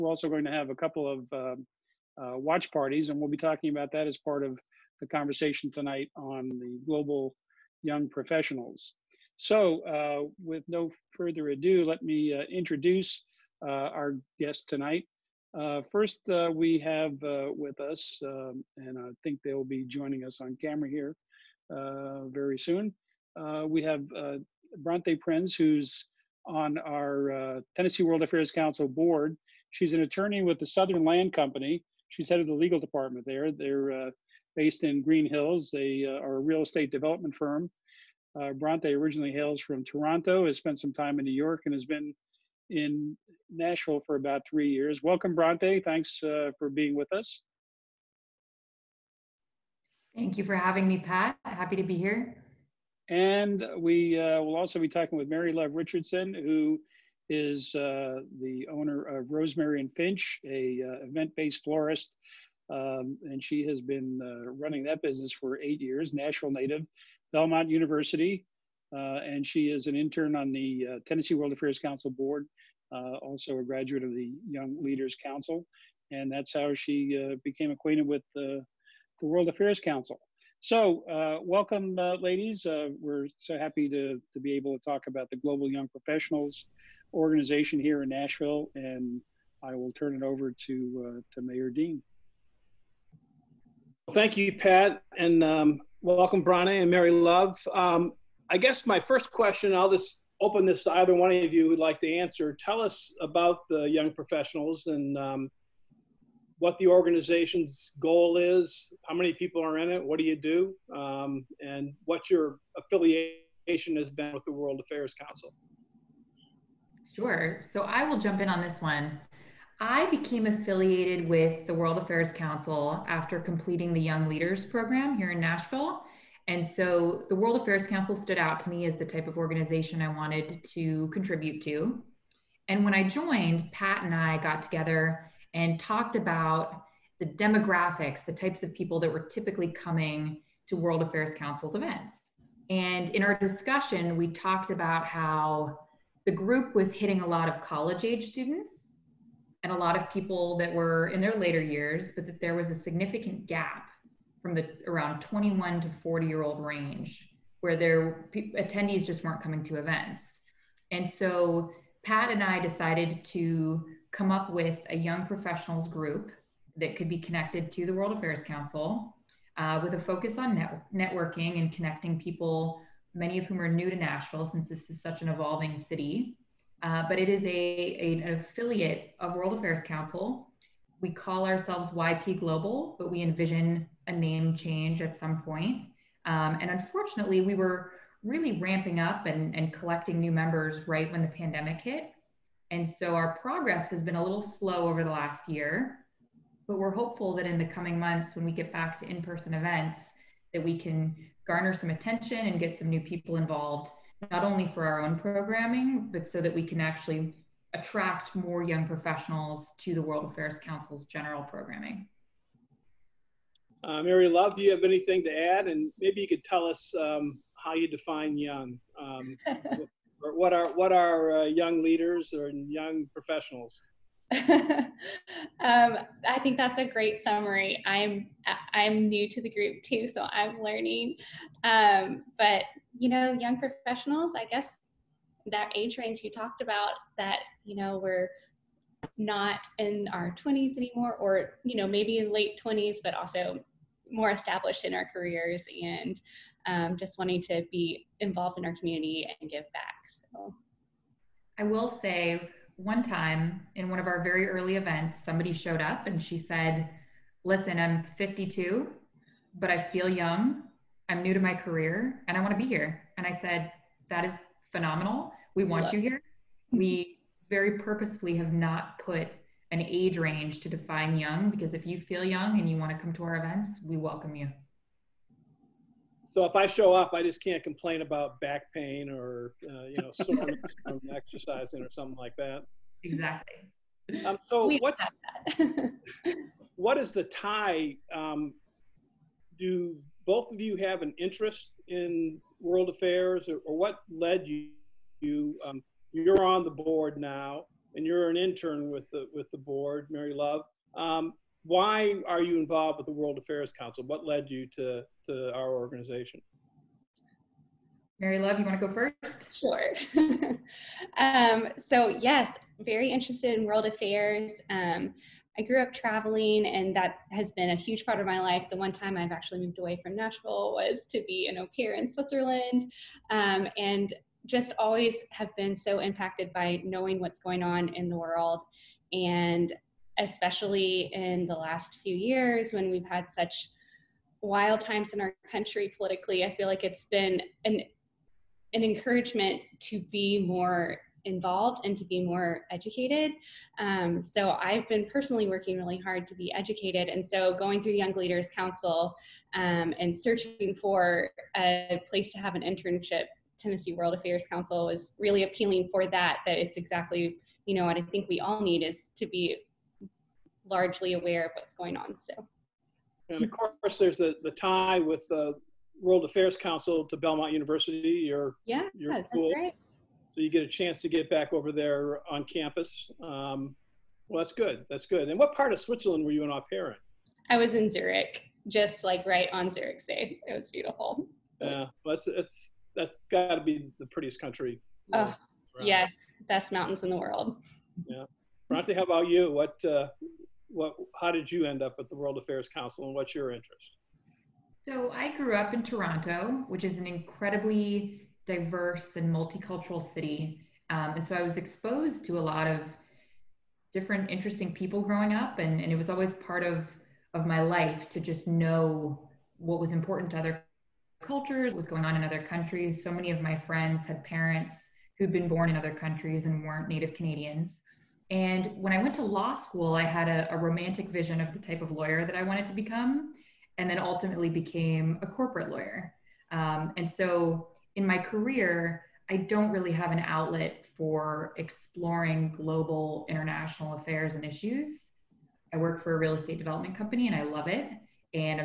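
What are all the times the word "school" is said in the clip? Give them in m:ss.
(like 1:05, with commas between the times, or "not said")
6:09, 6:59.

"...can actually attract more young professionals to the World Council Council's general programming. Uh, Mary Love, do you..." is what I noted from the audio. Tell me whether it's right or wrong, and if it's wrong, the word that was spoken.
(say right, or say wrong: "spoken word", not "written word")
wrong: "Affairs", not "Council".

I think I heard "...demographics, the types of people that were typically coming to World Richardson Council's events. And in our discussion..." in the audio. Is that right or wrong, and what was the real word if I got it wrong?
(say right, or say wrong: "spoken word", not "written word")
wrong: "Affairs", not "Richardson".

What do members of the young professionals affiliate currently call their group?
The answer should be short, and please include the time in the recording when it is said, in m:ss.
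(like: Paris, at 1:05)
YP Global, at 3:01.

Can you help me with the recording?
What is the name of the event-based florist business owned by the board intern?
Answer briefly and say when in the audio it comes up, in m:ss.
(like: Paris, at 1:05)
Rosemary and Finch, at 0:59.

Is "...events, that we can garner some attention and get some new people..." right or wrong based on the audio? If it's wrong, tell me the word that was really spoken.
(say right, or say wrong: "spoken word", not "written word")
right.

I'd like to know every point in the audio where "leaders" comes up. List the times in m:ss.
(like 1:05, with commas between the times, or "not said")
1:14, 2:04, 3:41, 5:48.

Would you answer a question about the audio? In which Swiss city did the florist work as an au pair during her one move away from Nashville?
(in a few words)
Zurich.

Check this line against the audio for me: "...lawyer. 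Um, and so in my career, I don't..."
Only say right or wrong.
right.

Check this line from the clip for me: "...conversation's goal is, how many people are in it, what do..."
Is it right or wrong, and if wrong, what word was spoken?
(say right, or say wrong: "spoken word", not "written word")
wrong: "organization", not "conversation".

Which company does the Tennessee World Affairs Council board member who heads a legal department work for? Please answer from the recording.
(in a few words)
Southern Land Company.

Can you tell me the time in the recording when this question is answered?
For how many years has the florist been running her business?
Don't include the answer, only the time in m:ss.
1:05.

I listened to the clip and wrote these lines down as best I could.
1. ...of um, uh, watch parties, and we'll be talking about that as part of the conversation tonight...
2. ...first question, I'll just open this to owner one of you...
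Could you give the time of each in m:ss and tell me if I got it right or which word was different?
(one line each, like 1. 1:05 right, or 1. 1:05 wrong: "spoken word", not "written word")
1. 0:01 right
2. 1:38 wrong: "either", not "owner".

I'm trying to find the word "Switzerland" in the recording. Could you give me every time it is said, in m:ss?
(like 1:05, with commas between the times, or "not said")
5:22, 6:15.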